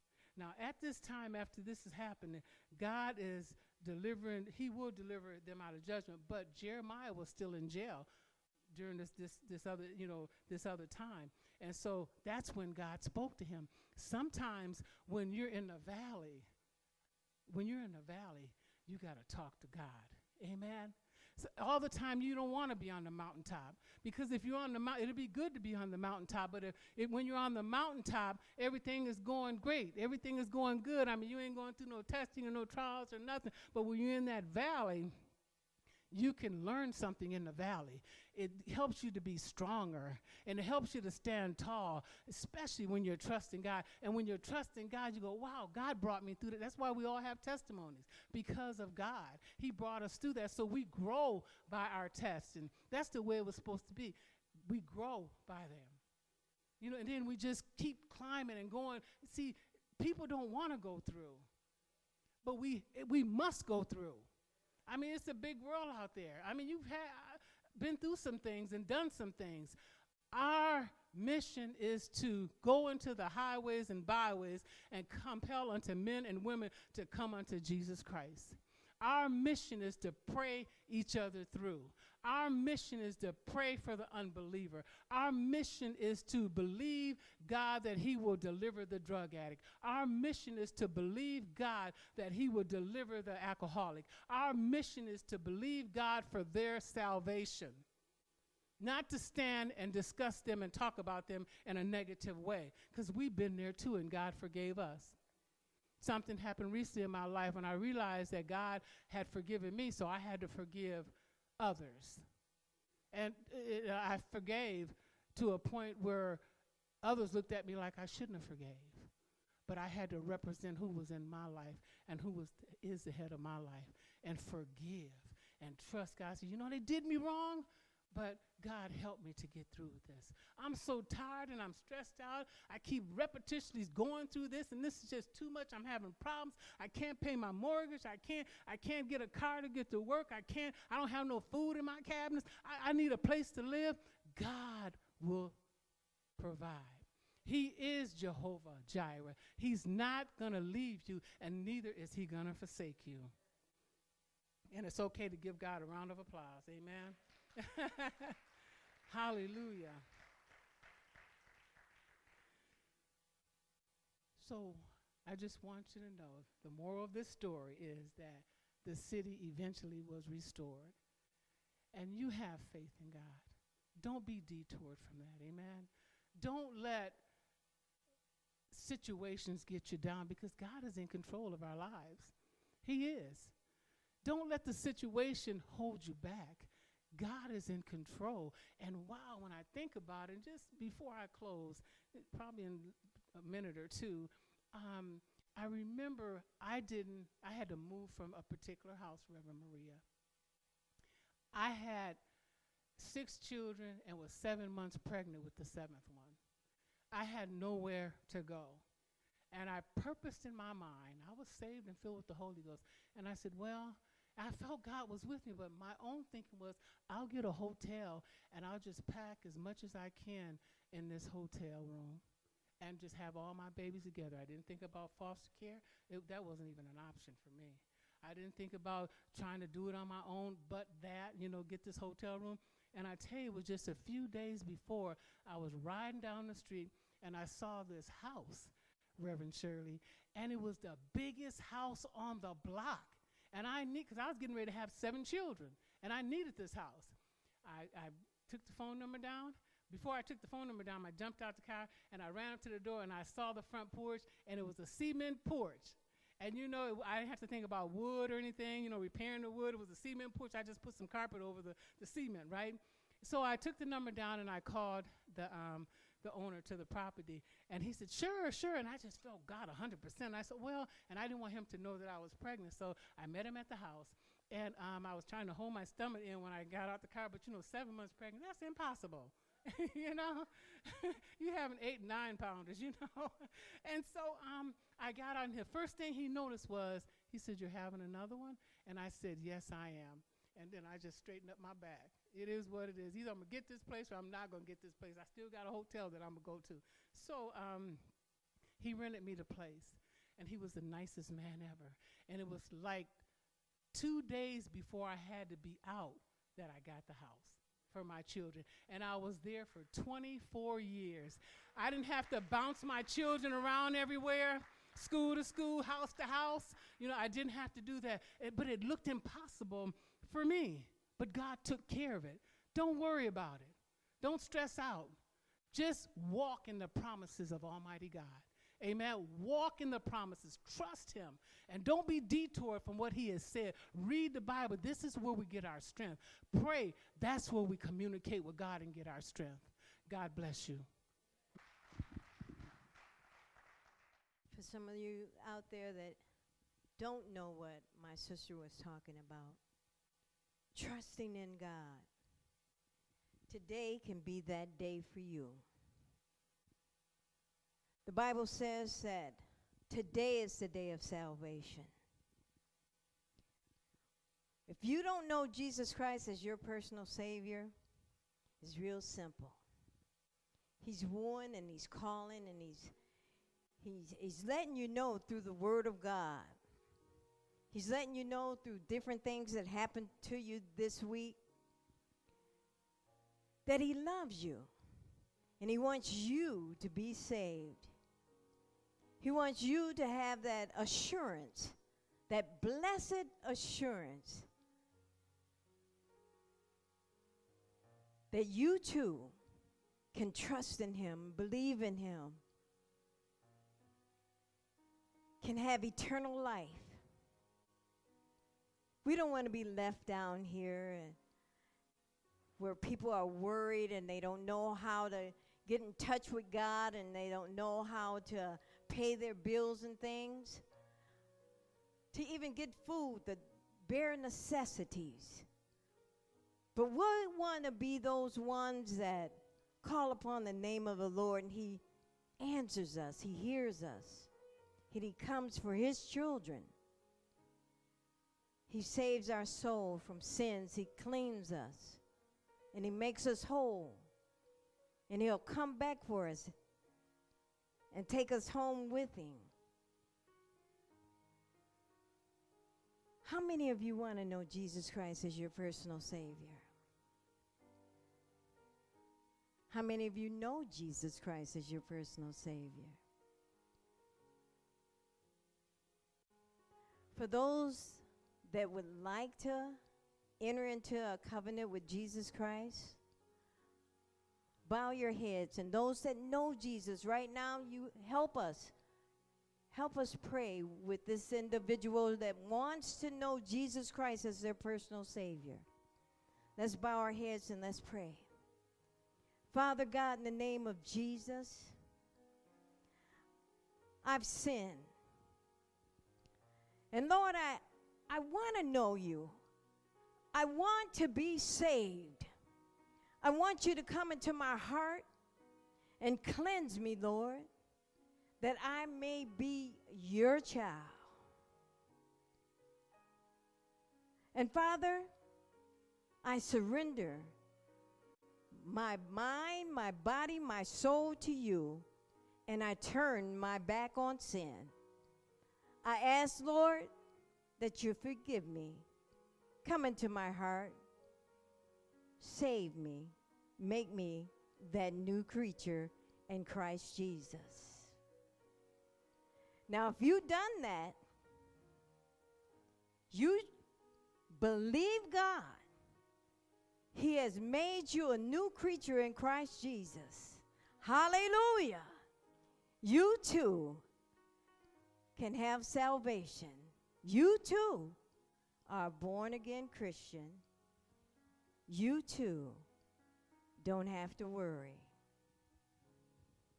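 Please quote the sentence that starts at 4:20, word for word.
I just put some carpet over the, the cement, right?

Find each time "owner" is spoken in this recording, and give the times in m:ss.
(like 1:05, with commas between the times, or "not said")
4:26.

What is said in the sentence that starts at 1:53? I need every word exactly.
And it, I forgave to a point where others looked at me like I shouldn't have forgave.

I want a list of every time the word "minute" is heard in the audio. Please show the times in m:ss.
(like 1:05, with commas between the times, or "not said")
3:13.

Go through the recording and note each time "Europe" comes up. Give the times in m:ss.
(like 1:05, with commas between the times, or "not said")
not said.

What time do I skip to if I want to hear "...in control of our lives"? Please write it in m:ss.
3:00.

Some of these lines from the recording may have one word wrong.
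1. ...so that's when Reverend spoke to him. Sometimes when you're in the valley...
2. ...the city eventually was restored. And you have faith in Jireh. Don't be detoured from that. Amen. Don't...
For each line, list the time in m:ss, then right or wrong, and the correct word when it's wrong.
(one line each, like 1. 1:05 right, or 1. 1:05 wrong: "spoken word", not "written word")
1. 0:11 wrong: "God", not "Reverend"
2. 2:48 wrong: "God", not "Jireh".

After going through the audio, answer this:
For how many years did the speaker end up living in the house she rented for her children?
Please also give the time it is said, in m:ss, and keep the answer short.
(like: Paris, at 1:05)
24, at 5:10.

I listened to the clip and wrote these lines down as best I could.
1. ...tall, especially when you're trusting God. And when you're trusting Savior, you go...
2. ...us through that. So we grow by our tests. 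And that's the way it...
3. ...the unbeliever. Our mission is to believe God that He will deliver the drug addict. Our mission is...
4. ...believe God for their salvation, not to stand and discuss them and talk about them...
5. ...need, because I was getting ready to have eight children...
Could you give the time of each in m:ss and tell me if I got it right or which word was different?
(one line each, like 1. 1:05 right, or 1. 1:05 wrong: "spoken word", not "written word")
1. 0:41 wrong: "God", not "Savior"
2. 0:50 right
3. 1:23 right
4. 1:35 right
5. 4:03 wrong: "seven", not "eight".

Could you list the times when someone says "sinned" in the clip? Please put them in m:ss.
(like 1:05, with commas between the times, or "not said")
8:14.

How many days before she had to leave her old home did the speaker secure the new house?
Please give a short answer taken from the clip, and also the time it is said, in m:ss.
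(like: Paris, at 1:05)
2, at 5:03.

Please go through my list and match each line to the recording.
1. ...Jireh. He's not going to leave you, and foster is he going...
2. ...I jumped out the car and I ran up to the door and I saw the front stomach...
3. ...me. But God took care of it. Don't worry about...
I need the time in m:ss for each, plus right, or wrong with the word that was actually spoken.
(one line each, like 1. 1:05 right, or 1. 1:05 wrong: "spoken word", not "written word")
1. 2:28 wrong: "neither", not "foster"
2. 4:11 wrong: "porch", not "stomach"
3. 5:20 right.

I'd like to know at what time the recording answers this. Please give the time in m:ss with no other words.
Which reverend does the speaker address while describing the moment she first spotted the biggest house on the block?
3:59.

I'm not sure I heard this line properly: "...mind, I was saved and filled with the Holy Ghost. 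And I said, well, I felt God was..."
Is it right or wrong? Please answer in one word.
right.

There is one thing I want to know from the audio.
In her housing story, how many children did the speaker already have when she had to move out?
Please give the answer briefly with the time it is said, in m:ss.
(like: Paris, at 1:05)
6, at 3:22.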